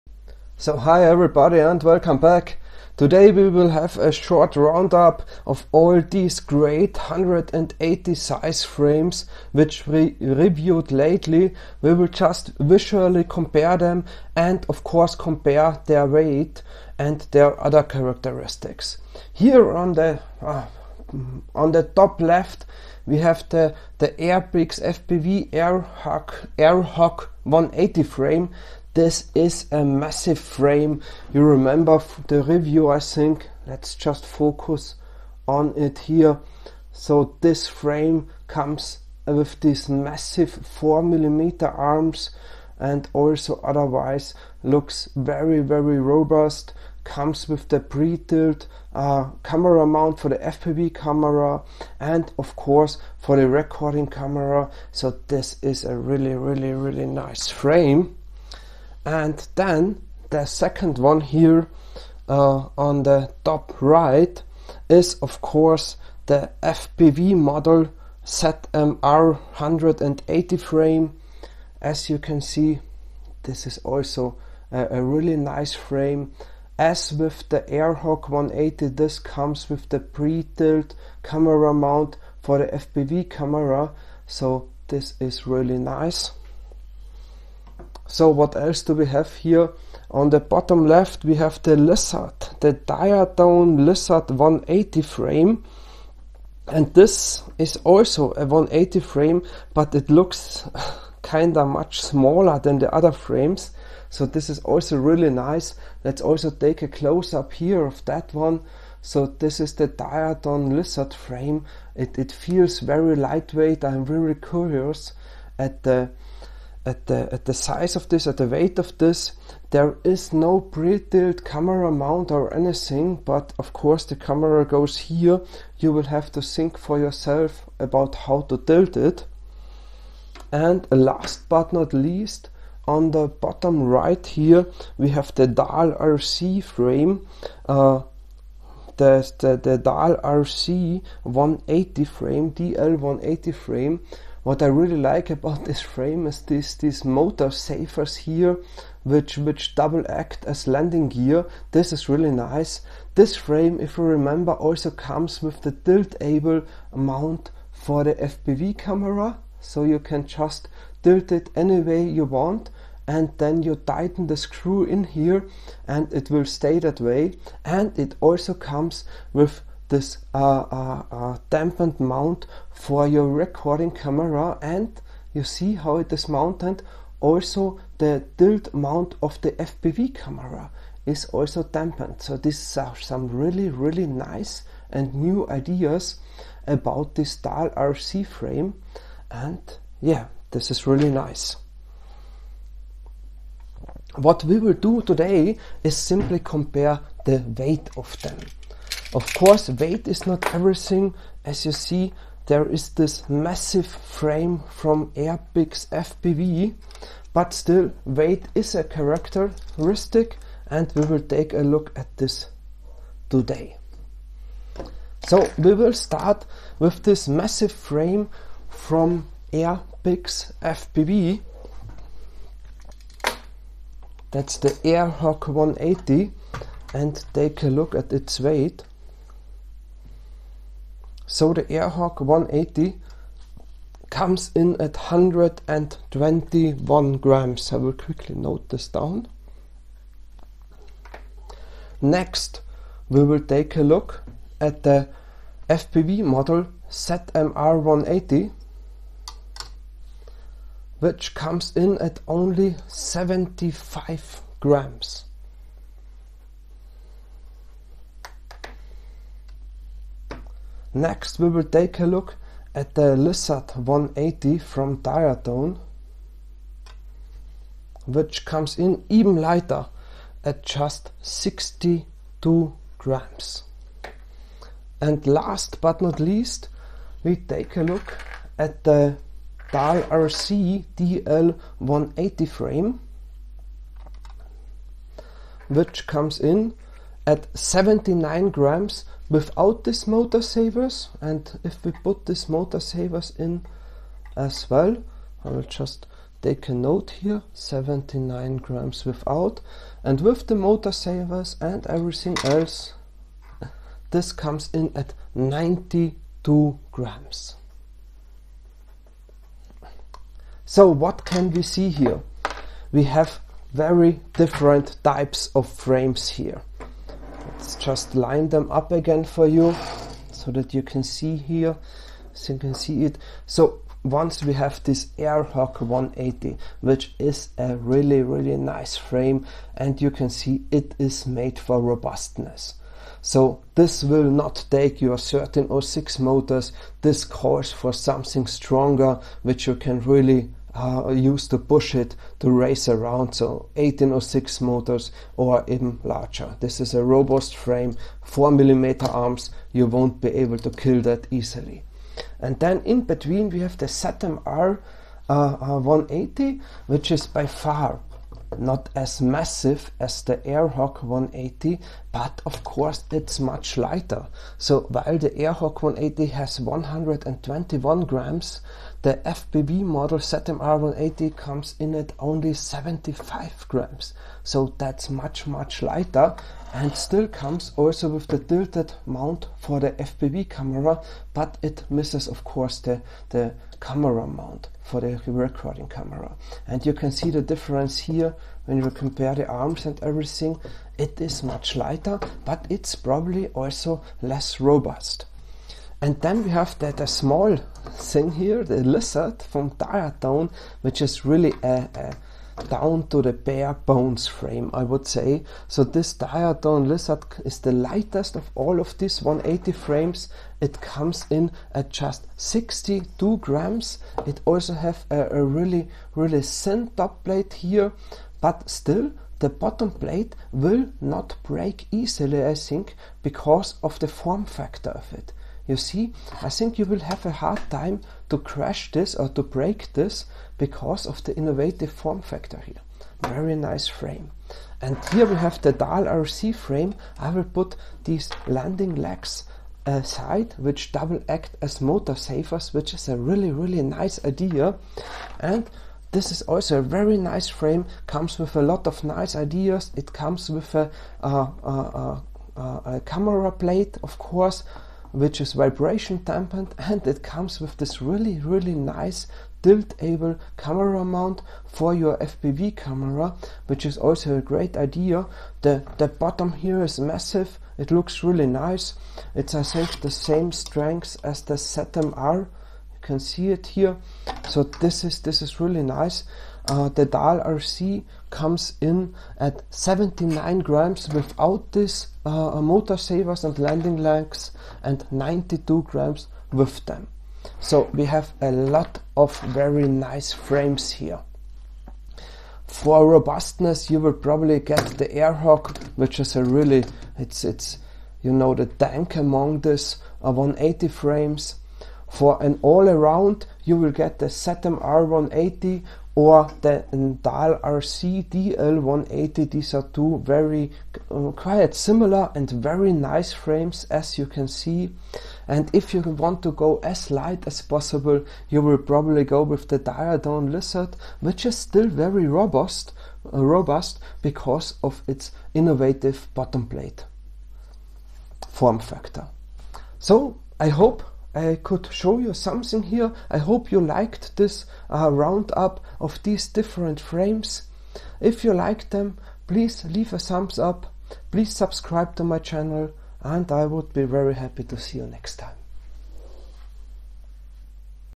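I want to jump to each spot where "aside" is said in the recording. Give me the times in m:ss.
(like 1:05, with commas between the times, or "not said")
7:19.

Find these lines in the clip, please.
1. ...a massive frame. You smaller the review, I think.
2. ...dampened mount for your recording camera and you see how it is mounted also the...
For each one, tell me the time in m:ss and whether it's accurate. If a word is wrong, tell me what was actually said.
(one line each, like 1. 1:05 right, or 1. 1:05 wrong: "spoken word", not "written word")
1. 0:29 wrong: "remember", not "smaller"
2. 2:51 right.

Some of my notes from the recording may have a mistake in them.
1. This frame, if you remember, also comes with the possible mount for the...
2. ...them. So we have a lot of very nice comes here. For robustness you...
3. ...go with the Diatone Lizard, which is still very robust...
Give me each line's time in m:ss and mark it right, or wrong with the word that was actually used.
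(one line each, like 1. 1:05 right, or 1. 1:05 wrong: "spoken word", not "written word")
1. 2:33 wrong: "tiltable", not "possible"
2. 8:06 wrong: "frames", not "comes"
3. 8:39 right.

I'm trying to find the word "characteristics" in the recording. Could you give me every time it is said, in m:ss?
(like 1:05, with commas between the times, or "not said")
0:17, 3:28.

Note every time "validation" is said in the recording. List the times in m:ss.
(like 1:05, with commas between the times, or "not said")
not said.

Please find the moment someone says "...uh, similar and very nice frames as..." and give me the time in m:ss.
8:31.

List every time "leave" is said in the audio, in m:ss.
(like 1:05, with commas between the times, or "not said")
8:59.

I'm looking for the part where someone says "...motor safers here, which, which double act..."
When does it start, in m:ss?
2:27.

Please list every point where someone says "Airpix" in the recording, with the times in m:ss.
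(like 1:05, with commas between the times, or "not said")
0:24, 3:25, 3:39.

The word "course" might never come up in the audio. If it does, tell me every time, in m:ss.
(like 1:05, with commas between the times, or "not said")
0:14, 0:52, 1:05, 2:03, 3:19, 6:02, 6:22, 7:34.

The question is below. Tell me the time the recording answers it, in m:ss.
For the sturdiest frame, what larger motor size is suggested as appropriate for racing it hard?
5:43.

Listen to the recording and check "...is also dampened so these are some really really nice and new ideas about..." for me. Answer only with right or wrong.
right.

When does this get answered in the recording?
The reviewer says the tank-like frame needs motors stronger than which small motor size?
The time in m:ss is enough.
5:35.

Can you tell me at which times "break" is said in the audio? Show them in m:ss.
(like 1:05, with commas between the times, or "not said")
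7:01, 7:09.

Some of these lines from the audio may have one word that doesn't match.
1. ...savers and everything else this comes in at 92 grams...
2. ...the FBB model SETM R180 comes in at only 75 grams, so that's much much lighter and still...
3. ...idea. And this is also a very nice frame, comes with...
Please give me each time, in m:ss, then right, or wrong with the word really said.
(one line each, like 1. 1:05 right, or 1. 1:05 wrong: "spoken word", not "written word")
1. 5:00 right
2. 6:09 right
3. 7:24 right.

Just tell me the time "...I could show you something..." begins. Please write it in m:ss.
8:51.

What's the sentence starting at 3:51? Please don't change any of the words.
So the Air Hog 180 comes in at 121 grams.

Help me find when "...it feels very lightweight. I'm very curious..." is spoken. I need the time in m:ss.
1:52.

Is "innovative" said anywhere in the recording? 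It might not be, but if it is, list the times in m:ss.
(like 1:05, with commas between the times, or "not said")
7:11, 8:45.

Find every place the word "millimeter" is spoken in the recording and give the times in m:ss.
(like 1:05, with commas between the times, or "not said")
0:41, 5:48.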